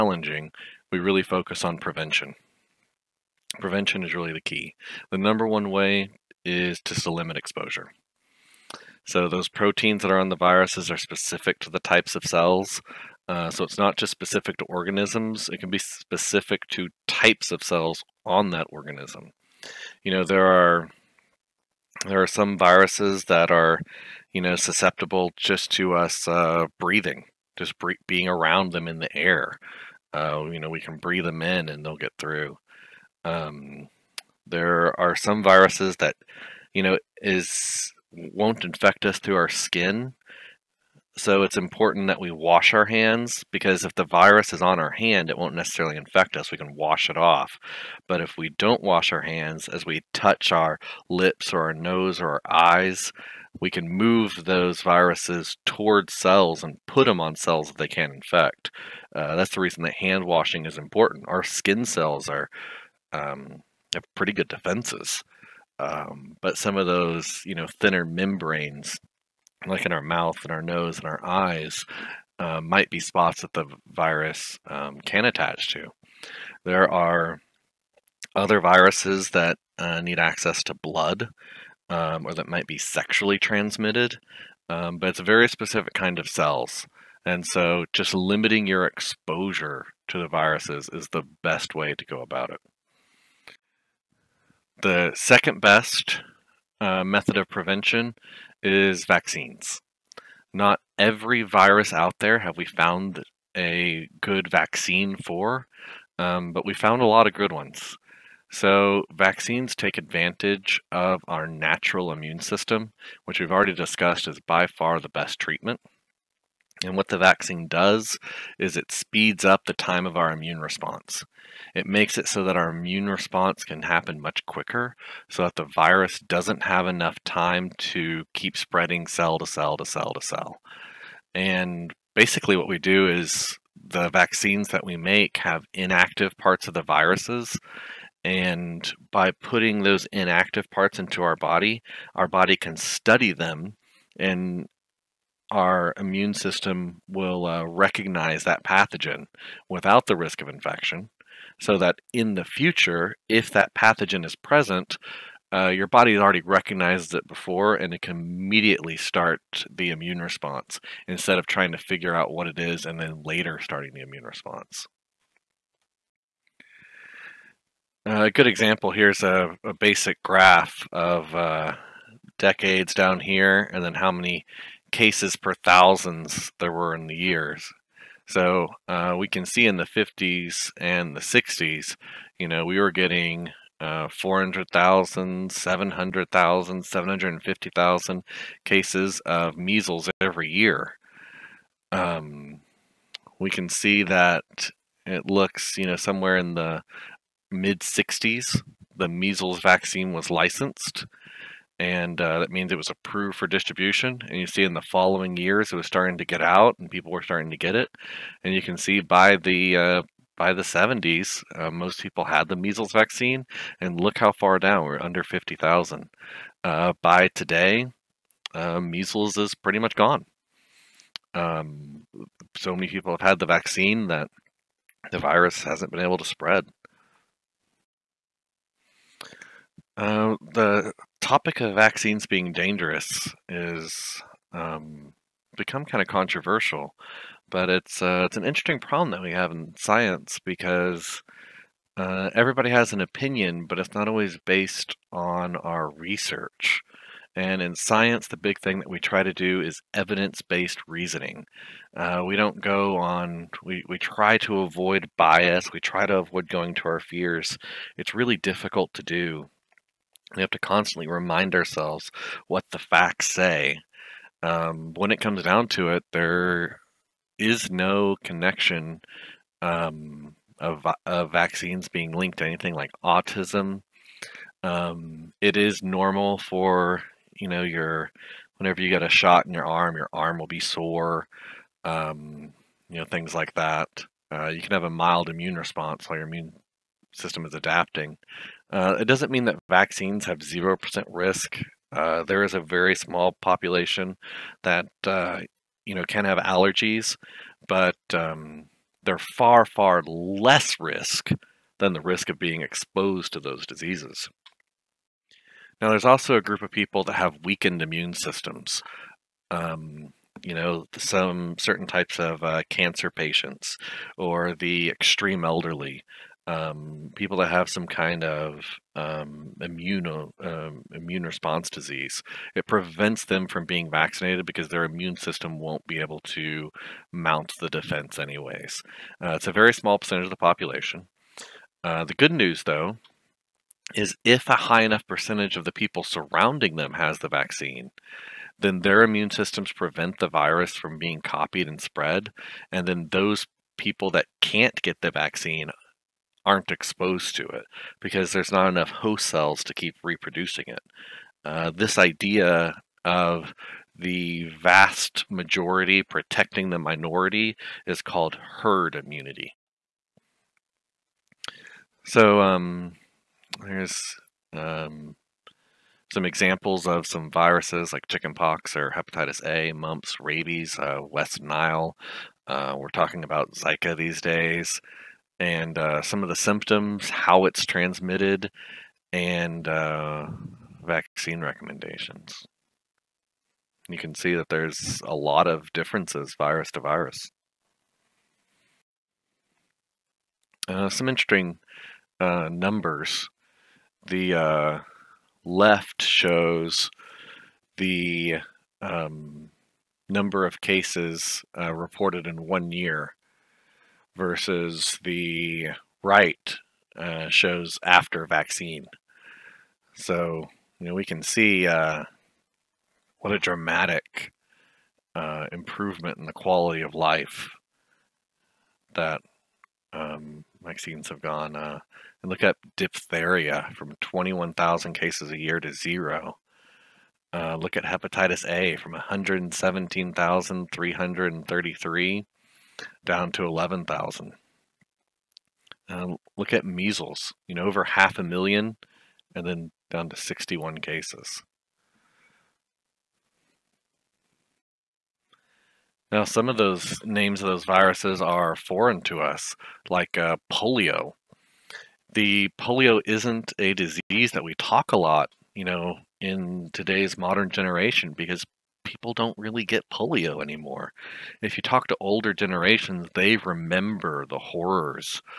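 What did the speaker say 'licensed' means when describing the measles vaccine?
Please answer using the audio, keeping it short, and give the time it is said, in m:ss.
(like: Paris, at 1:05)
approved for distribution, at 3:22.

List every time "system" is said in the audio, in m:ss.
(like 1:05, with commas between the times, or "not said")
1:52, 2:26, 4:47, 5:08, 5:25, 5:39.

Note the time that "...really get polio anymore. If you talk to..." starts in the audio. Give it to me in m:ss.
7:39.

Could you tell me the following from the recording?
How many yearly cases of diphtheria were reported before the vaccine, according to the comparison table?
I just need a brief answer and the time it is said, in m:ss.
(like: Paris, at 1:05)
21,000, at 7:03.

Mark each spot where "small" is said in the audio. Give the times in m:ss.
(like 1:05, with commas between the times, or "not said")
4:52, 5:29.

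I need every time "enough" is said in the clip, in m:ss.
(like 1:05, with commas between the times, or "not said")
2:06, 5:34, 5:48.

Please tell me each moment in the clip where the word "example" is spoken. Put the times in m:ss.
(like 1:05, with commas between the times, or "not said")
2:48, 6:06.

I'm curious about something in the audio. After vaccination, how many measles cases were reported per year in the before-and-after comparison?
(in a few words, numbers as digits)
61.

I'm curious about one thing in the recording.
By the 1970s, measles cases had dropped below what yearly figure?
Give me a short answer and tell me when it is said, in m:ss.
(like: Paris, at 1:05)
50,000, at 3:35.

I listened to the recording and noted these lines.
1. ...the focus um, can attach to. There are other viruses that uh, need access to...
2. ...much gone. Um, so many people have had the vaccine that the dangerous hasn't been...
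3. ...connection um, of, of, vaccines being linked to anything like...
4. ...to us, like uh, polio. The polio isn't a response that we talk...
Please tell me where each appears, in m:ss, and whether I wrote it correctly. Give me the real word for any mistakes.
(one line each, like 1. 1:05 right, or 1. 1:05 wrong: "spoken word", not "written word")
1. 1:13 wrong: "virus", not "focus"
2. 3:39 wrong: "virus", not "dangerous"
3. 4:28 right
4. 7:29 wrong: "disease", not "response".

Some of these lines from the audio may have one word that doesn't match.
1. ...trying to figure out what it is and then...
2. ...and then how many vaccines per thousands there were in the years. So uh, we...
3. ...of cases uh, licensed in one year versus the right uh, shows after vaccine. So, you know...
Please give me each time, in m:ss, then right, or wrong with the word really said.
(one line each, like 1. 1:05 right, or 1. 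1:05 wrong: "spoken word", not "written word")
1. 2:41 right
2. 2:53 wrong: "cases", not "vaccines"
3. 6:40 wrong: "reported", not "licensed".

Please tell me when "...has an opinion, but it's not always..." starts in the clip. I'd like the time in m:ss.
4:02.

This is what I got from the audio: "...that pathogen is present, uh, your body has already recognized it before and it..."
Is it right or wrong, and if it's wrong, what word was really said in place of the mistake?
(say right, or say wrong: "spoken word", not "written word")
right.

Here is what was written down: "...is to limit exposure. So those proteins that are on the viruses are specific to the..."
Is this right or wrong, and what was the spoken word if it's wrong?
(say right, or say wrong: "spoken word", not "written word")
right.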